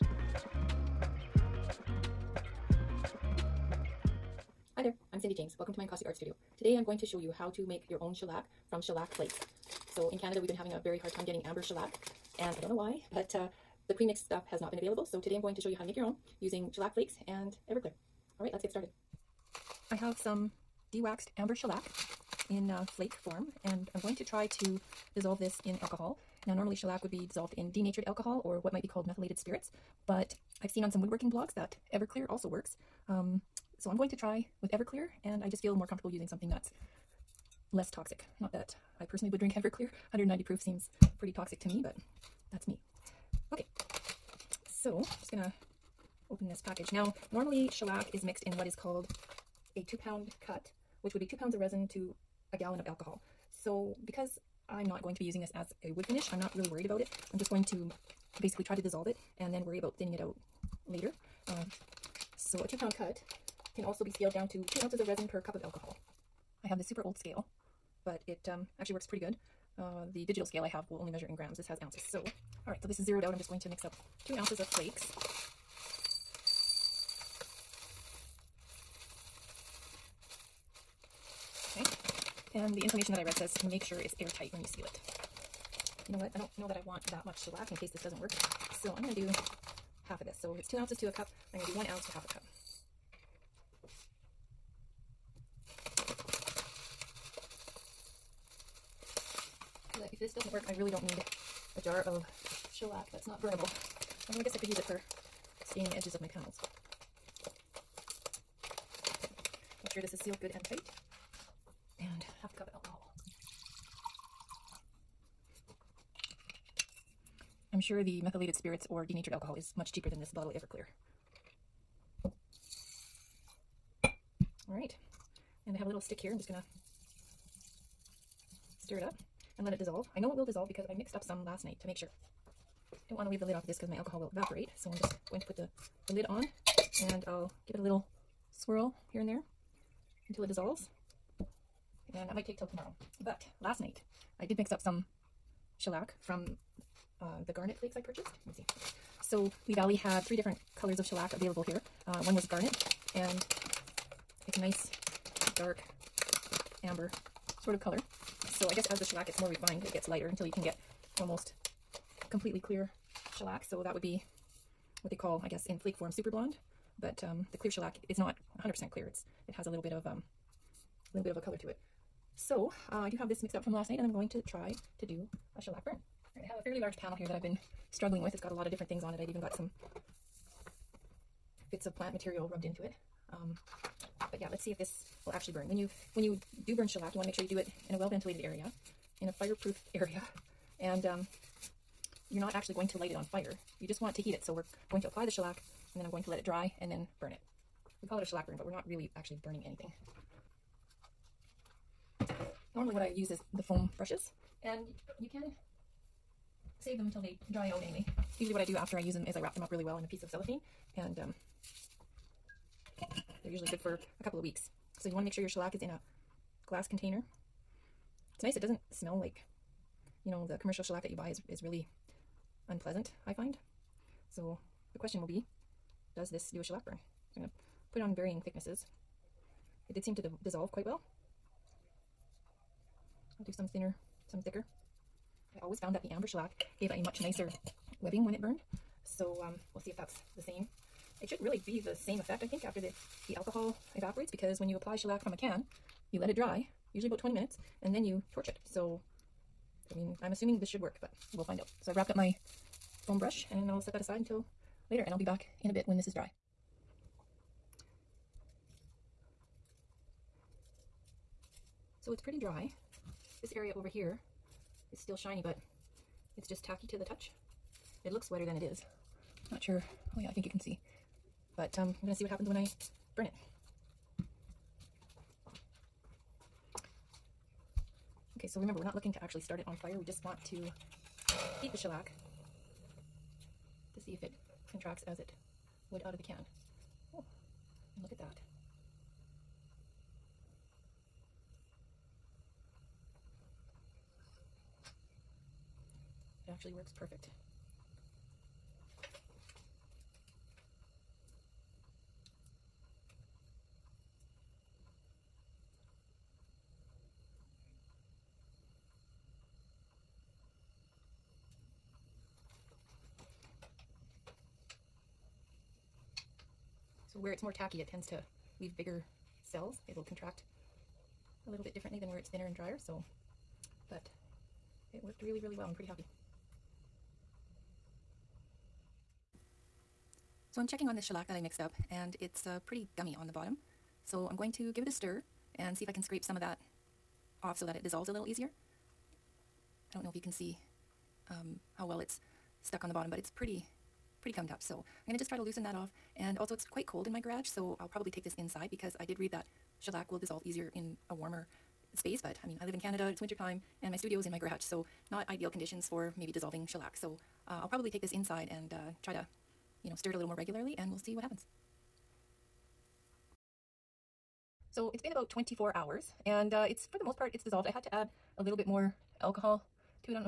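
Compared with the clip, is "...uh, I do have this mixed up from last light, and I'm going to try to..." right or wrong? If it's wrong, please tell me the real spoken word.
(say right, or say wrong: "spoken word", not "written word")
wrong: "night", not "light".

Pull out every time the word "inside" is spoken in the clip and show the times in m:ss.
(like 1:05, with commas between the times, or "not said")
5:48, 5:58.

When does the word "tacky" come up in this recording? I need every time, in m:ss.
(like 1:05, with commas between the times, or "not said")
4:26, 5:17.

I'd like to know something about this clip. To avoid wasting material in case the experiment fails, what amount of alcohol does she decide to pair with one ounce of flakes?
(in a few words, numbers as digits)
half a cup.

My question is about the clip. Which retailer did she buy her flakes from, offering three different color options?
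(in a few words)
Lee Valley.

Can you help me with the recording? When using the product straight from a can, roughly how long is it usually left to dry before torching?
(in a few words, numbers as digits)
20 minutes.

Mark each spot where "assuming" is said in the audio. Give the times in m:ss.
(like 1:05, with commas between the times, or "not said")
4:10.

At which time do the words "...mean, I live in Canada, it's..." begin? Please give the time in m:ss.
5:52.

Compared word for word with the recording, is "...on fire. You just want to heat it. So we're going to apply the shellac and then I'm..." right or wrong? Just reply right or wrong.
right.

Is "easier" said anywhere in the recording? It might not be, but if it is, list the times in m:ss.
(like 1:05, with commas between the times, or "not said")
5:38, 5:50.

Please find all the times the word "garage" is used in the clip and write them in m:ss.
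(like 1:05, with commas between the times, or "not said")
5:47, 5:54.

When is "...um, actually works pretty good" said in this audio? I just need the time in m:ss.
1:08.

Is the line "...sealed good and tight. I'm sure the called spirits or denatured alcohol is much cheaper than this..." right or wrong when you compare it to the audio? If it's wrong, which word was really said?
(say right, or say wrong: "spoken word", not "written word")
wrong: "methylated", not "called".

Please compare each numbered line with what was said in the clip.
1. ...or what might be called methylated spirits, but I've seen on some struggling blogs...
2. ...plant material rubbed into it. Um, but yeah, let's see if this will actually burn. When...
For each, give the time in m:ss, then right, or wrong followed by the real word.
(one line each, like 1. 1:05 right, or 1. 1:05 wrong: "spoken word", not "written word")
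1. 0:28 wrong: "woodworking", not "struggling"
2. 3:01 right.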